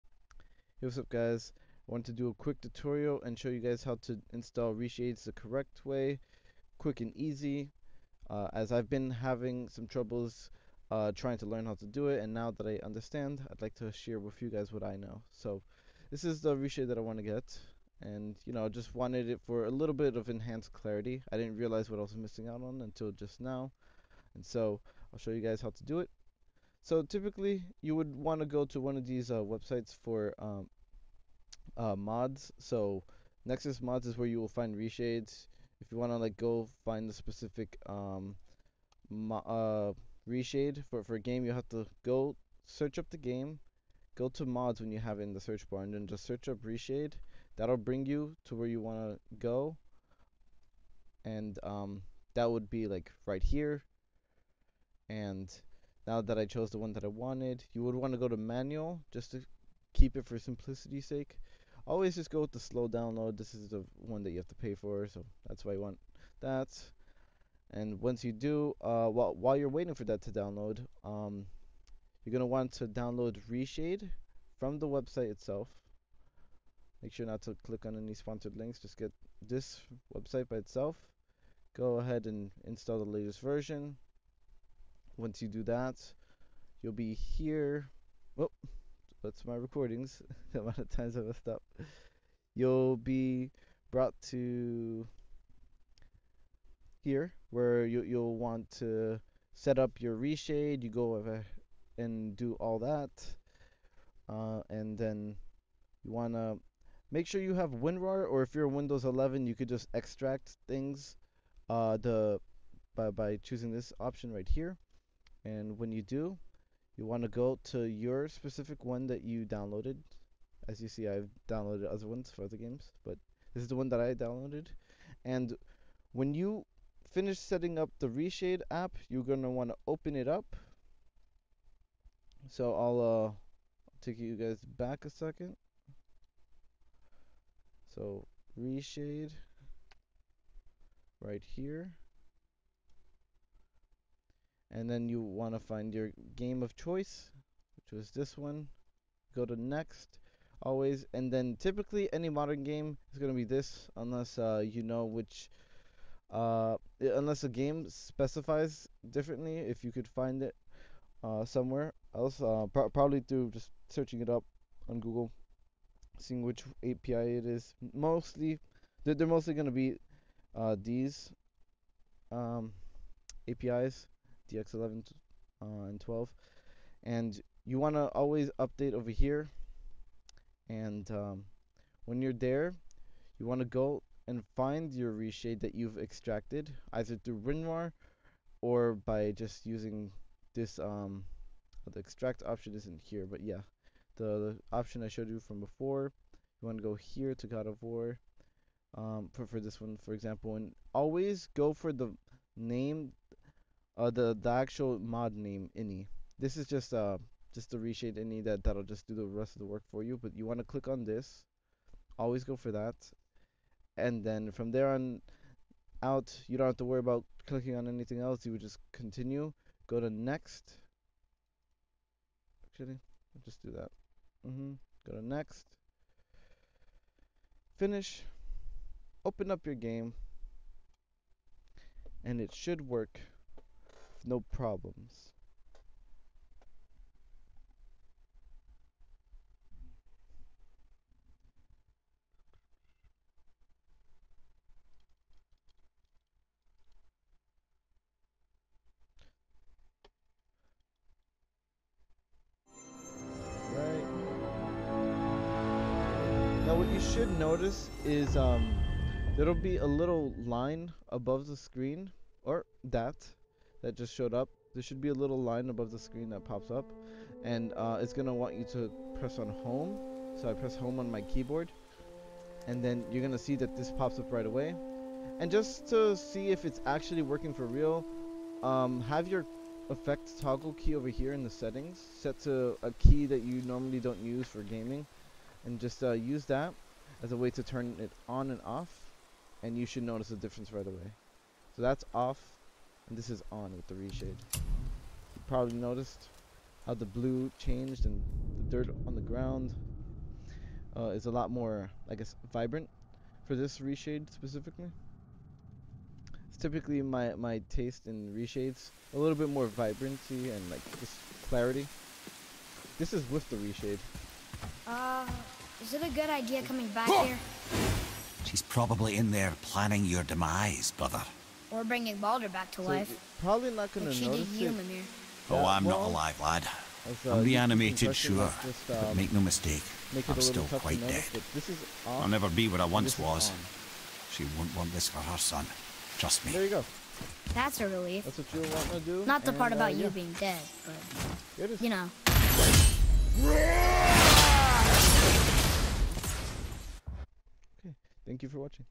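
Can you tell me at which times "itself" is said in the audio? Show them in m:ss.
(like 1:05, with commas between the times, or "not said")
1:15, 1:20.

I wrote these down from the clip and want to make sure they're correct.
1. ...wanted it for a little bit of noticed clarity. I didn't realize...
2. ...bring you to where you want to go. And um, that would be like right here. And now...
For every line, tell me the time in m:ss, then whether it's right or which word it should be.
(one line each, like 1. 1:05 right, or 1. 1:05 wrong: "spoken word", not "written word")
1. 0:18 wrong: "enhanced", not "noticed"
2. 0:47 right.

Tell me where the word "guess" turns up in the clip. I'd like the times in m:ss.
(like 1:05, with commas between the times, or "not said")
5:02.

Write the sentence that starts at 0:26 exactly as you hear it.
So typically you would want to go to one of these uh, websites for um, uh, mods.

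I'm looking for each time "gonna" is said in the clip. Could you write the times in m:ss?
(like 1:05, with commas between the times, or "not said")
4:28, 4:33, 5:23.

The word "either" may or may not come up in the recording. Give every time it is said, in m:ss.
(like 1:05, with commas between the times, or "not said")
3:06.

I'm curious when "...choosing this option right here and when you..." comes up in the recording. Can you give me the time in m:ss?
1:53.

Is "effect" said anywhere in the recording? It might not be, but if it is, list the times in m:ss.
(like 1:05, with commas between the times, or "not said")
4:39.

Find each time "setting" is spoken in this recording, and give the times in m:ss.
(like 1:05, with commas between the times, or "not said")
2:07, 4:41.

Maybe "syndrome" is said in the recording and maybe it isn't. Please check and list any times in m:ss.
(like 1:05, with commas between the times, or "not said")
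not said.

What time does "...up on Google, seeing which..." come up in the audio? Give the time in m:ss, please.
2:44.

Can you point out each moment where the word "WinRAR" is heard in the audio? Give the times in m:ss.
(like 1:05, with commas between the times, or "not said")
1:47, 3:07.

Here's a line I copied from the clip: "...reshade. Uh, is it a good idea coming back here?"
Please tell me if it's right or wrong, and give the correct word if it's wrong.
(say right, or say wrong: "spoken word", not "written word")
right.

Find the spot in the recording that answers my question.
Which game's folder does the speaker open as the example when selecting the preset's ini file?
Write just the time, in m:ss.
3:17.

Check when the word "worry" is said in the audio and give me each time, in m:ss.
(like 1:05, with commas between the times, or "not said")
3:36.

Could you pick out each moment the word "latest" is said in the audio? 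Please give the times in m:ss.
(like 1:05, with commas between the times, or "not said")
1:23.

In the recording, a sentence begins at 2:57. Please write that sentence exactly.
And you want to always update over here.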